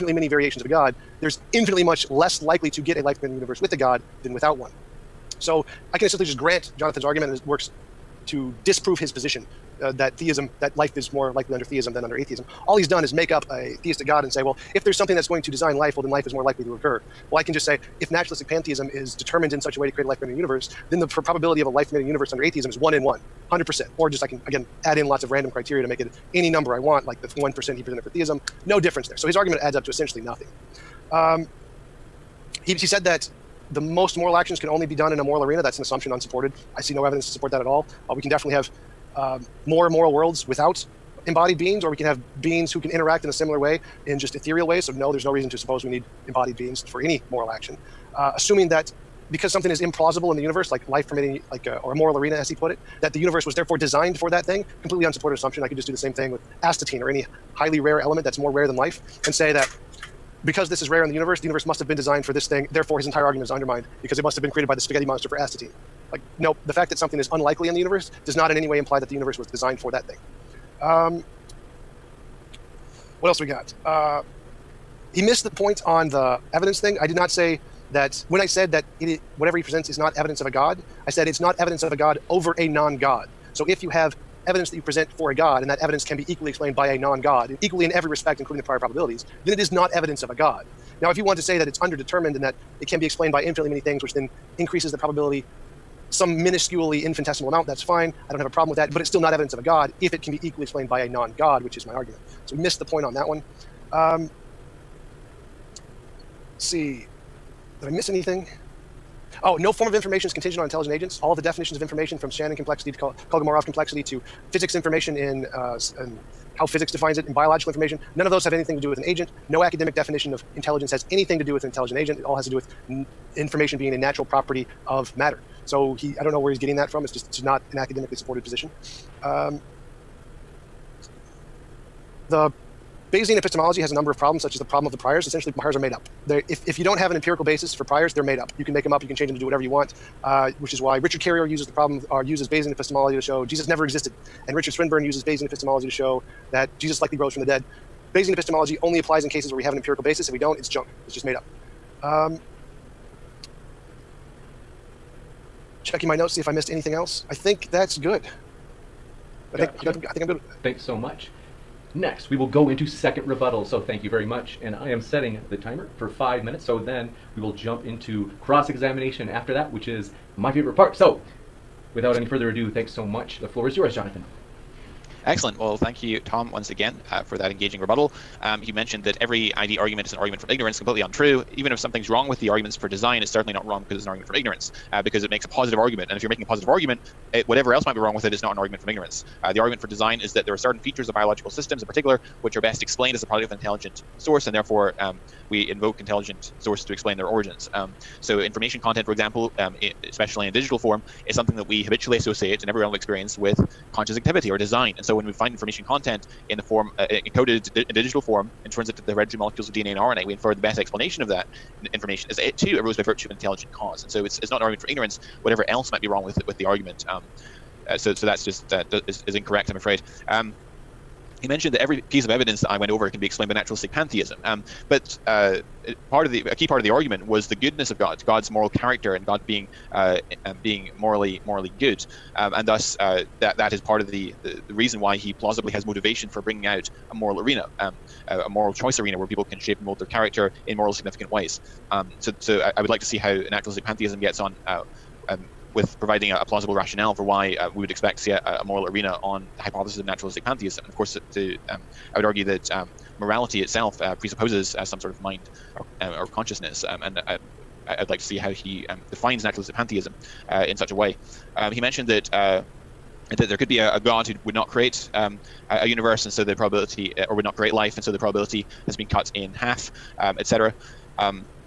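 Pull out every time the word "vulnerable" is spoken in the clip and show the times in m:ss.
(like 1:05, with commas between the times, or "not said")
not said.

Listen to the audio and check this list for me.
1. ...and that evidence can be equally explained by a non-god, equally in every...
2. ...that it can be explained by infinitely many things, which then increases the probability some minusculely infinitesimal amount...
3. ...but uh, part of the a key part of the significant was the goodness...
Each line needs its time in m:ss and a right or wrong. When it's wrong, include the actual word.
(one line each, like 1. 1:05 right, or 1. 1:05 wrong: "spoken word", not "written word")
1. 1:25 right
2. 1:32 right
3. 3:44 wrong: "argument", not "significant".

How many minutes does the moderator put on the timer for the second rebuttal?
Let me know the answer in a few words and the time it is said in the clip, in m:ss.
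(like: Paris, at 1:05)
5, at 2:46.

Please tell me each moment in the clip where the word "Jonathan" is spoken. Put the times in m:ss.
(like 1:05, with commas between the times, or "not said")
0:06, 2:53.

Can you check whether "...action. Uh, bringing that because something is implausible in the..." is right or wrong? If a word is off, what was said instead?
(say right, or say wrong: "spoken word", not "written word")
wrong: "assuming", not "bringing".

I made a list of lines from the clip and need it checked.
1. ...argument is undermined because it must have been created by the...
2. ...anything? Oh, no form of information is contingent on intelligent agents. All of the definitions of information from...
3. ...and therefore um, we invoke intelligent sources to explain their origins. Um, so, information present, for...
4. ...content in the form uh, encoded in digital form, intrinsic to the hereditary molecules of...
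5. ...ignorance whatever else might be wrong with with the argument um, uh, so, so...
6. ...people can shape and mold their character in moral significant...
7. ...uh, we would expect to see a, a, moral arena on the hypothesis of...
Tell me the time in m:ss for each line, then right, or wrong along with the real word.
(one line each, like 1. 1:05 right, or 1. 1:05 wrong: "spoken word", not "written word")
1. 1:03 right
2. 1:48 right
3. 3:14 wrong: "content", not "present"
4. 3:25 right
5. 3:34 right
6. 3:59 right
7. 4:07 right.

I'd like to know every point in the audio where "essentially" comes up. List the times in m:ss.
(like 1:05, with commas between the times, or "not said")
0:06, 0:29, 2:15.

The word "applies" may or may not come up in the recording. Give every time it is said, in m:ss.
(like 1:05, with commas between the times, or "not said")
2:28.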